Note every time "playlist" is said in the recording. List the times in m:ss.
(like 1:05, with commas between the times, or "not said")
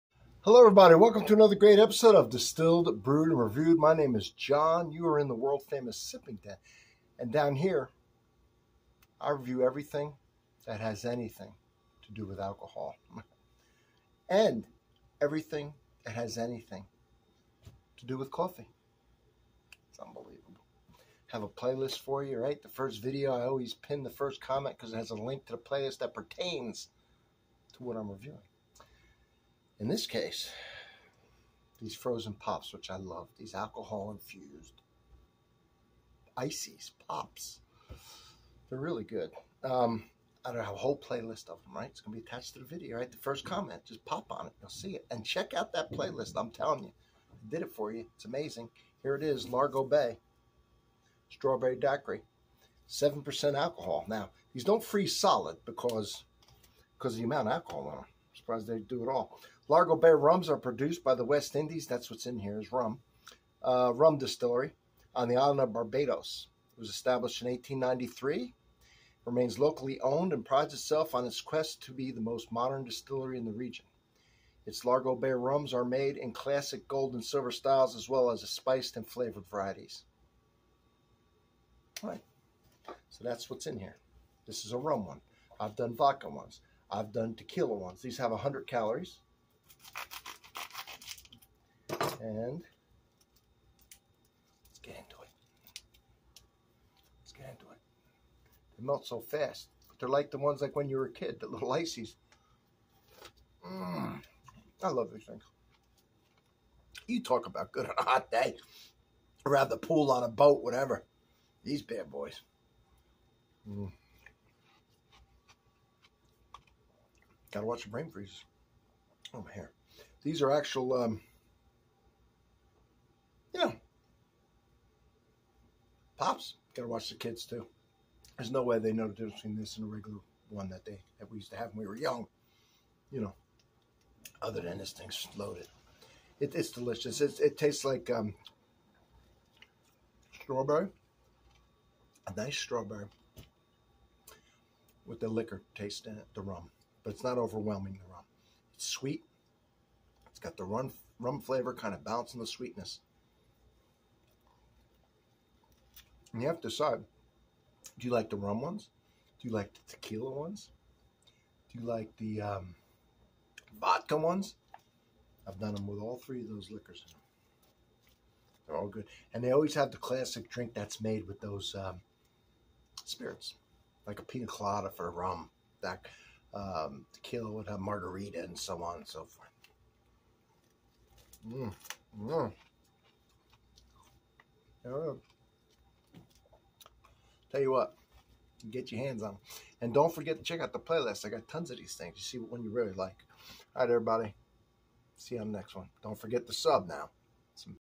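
0:21, 0:25, 0:40, 0:45, 3:10.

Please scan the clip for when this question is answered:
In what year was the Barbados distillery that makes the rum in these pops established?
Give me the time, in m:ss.
1:07.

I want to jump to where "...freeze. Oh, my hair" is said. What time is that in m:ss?
1:58.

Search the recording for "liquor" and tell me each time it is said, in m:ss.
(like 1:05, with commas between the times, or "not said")
2:25, 2:46.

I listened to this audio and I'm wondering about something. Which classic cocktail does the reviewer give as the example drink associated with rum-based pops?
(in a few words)
Pina colada.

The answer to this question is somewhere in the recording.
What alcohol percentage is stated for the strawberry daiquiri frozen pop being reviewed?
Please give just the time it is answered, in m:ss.
0:52.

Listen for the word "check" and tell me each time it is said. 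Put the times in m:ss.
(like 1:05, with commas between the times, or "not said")
0:45, 3:10.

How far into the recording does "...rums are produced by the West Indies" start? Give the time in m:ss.
1:00.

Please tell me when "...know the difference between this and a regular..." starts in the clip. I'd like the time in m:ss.
2:08.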